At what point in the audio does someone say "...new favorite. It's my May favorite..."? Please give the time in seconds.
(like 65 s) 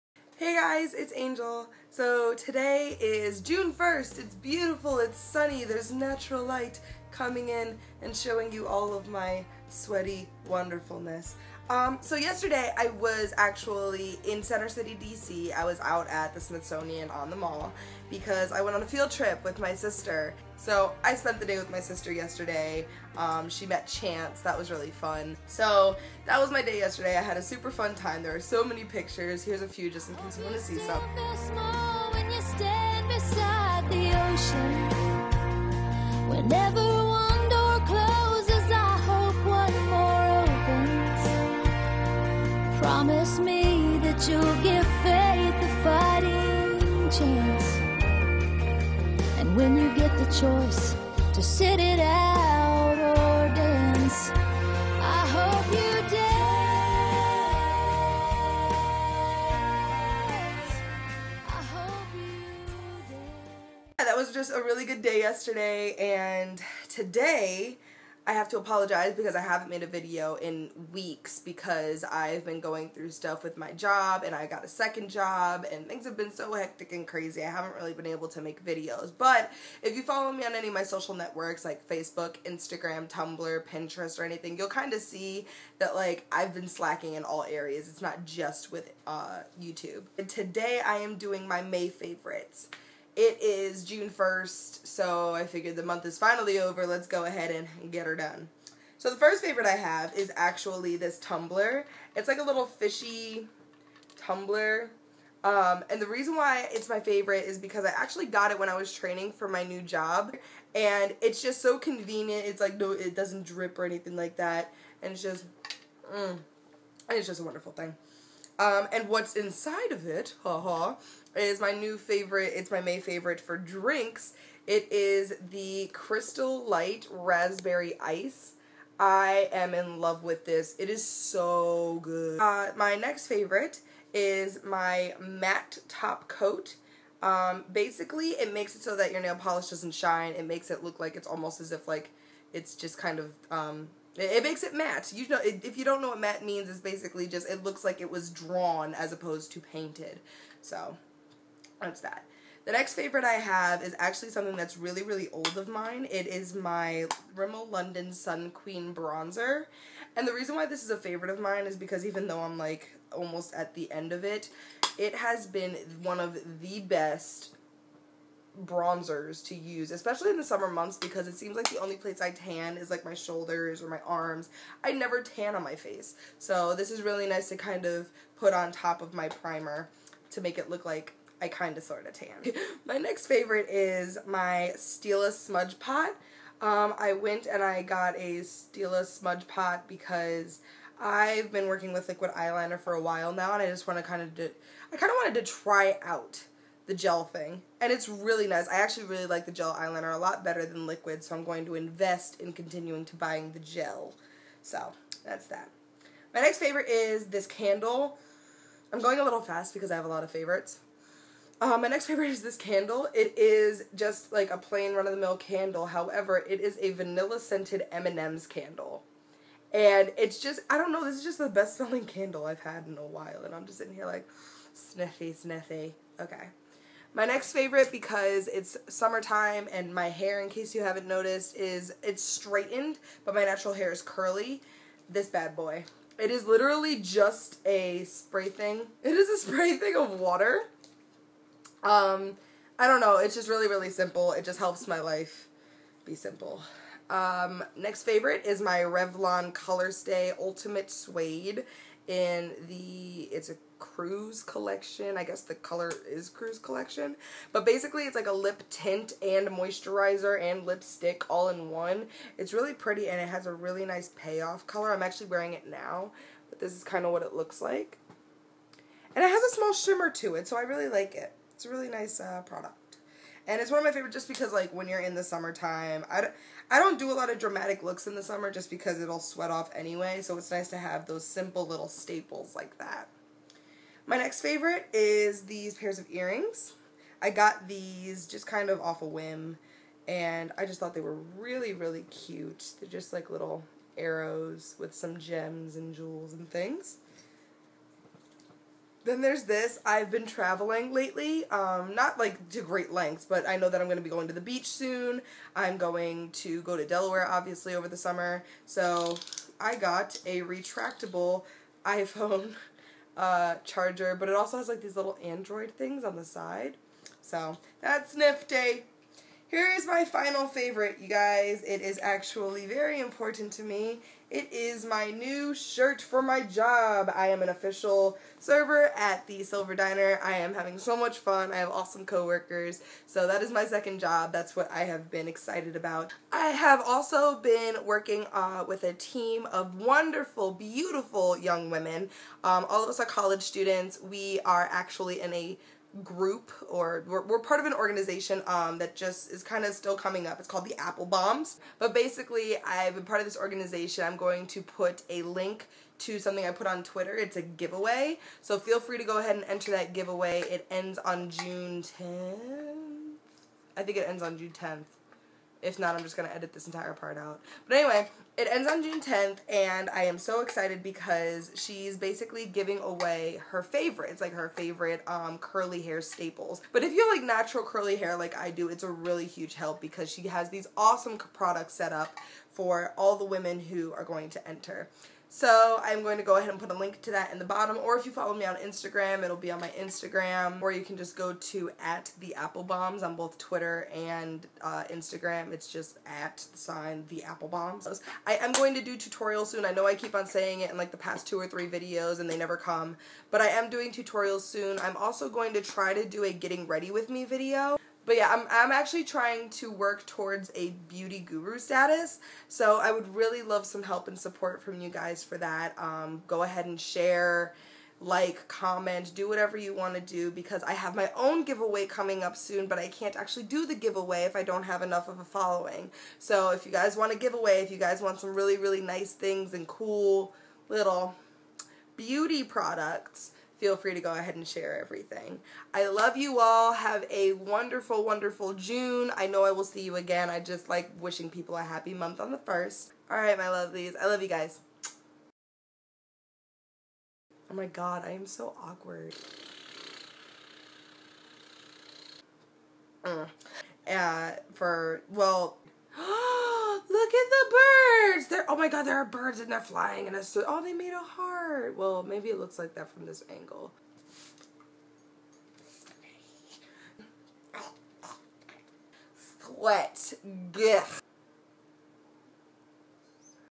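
121 s.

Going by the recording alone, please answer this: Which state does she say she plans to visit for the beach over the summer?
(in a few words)
Delaware.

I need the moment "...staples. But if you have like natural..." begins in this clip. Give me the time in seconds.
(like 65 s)
376 s.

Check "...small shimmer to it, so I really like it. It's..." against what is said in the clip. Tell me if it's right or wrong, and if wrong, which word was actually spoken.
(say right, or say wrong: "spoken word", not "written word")
right.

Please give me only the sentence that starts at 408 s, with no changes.
But yeah, I'm, I'm actually trying to work towards a beauty guru status.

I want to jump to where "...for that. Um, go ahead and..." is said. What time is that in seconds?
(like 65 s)
415 s.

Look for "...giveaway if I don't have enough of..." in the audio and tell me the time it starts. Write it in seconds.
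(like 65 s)
423 s.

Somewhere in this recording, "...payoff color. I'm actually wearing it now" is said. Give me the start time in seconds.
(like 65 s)
264 s.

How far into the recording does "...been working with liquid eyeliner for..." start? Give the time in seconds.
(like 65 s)
191 s.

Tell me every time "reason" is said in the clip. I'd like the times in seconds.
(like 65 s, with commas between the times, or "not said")
106 s, 160 s.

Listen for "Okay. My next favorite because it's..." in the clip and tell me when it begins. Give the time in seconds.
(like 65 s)
226 s.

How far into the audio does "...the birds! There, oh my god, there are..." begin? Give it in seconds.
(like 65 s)
457 s.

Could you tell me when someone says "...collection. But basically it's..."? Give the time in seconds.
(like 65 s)
256 s.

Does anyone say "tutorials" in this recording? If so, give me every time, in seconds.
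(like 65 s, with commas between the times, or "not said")
398 s, 403 s.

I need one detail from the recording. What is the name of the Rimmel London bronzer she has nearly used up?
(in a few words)
Sun Queen.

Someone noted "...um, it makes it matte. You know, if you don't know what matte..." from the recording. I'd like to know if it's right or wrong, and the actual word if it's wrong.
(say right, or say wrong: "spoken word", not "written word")
right.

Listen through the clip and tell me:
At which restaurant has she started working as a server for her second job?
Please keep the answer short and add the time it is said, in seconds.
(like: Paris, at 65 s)
Silver Diner, at 329 s.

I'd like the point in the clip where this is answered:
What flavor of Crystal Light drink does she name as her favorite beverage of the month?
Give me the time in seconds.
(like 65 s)
127 s.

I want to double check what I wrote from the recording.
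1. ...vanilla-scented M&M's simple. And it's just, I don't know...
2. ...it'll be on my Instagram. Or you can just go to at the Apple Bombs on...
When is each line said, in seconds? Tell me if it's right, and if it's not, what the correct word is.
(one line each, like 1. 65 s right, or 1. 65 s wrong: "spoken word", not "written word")
1. 216 s wrong: "candle", not "simple"
2. 389 s right.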